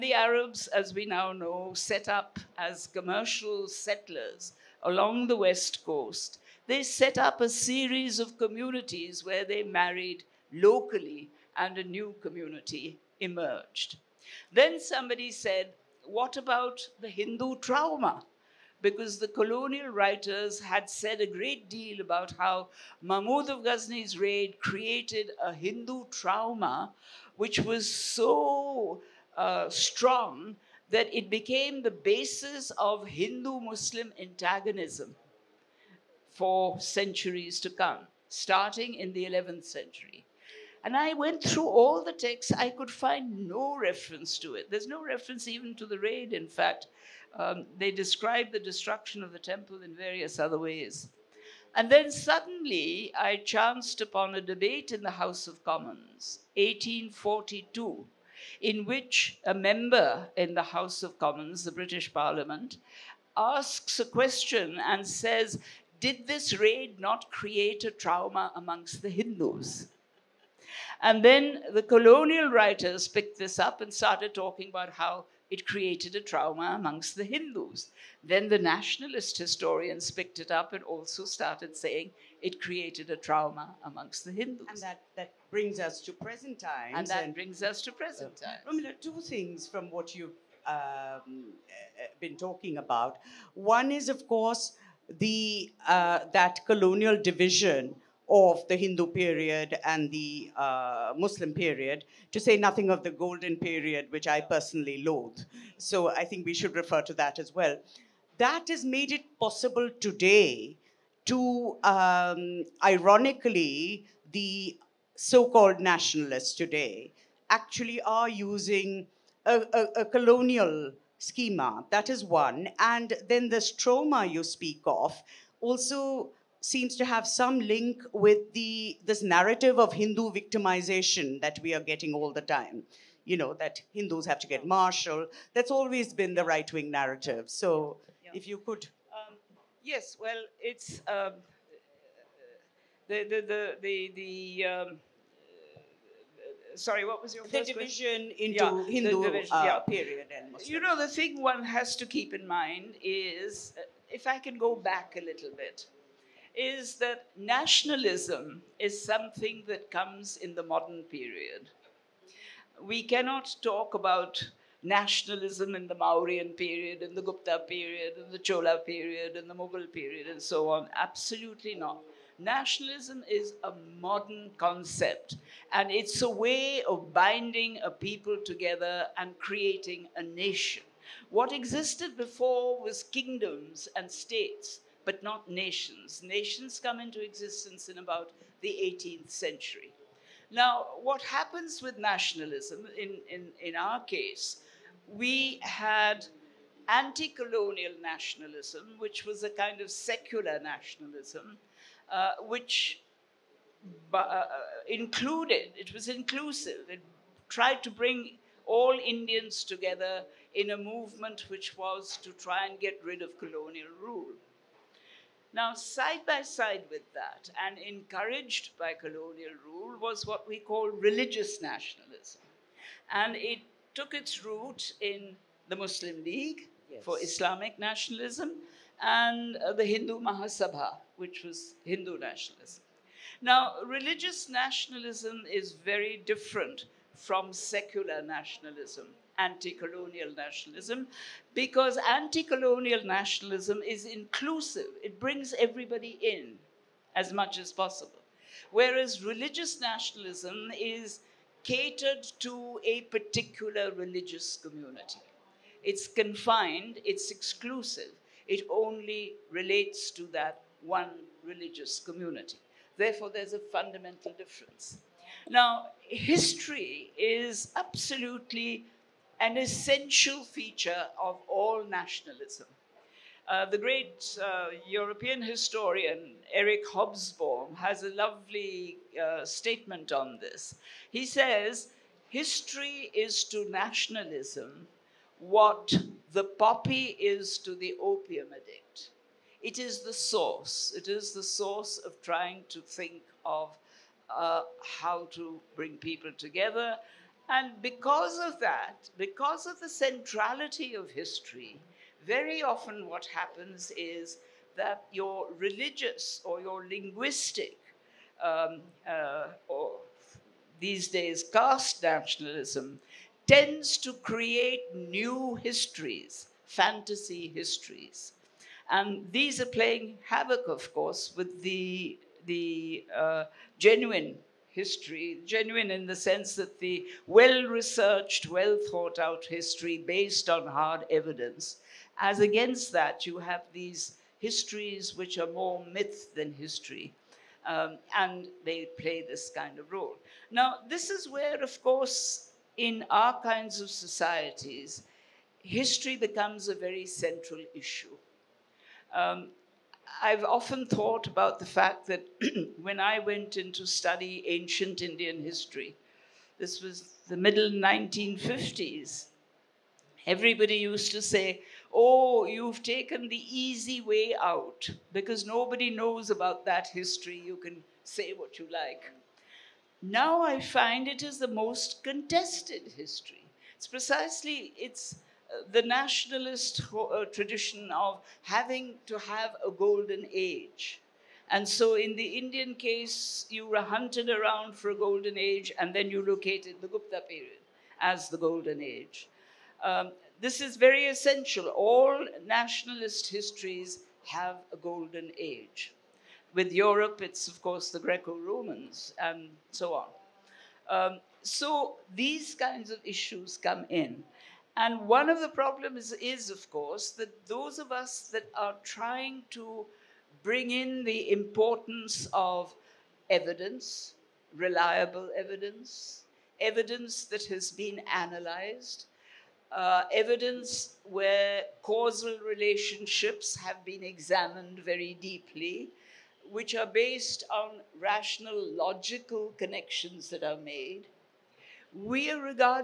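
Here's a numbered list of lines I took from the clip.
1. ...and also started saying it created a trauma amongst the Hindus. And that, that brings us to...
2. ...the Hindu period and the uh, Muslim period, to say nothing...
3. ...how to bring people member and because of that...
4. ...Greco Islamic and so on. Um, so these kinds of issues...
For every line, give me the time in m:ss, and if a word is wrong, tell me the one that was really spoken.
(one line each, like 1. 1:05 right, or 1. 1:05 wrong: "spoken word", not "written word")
1. 1:20 right
2. 1:38 right
3. 4:54 wrong: "together", not "member"
4. 6:37 wrong: "Romans", not "Islamic".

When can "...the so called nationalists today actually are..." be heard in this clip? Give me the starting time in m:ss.
1:54.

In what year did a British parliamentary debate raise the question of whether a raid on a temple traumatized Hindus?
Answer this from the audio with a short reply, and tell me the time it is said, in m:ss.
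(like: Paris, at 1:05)
1842, at 0:56.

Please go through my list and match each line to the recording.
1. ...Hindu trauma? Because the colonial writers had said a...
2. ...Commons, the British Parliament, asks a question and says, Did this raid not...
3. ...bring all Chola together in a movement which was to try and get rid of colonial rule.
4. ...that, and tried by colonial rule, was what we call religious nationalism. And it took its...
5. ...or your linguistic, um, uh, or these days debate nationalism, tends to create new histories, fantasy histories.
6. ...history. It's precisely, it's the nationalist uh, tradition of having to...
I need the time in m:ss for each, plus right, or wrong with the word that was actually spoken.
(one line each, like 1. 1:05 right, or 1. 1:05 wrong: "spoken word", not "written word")
1. 0:17 right
2. 1:01 right
3. 3:27 wrong: "Indians", not "Chola"
4. 3:37 wrong: "encouraged", not "tried"
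5. 5:06 wrong: "caste", not "debate"
6. 6:12 right.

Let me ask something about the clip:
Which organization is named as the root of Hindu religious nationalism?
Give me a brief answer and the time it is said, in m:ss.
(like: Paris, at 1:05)
Hindu Mahasabha, at 3:49.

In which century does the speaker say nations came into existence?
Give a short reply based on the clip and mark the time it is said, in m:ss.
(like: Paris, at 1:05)
18th century, at 3:08.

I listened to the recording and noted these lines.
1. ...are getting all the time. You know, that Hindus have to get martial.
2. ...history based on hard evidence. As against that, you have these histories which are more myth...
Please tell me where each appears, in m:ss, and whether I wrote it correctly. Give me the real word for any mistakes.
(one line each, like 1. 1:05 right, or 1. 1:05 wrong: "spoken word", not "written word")
1. 2:11 right
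2. 5:29 right.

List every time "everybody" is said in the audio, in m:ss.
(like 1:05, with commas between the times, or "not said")
4:05, 6:00.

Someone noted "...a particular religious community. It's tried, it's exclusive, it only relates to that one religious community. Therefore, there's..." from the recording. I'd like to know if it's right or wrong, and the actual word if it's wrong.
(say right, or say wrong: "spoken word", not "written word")
wrong: "confined", not "tried".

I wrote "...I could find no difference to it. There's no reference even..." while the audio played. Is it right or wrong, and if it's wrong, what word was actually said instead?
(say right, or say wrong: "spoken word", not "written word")
wrong: "reference", not "difference".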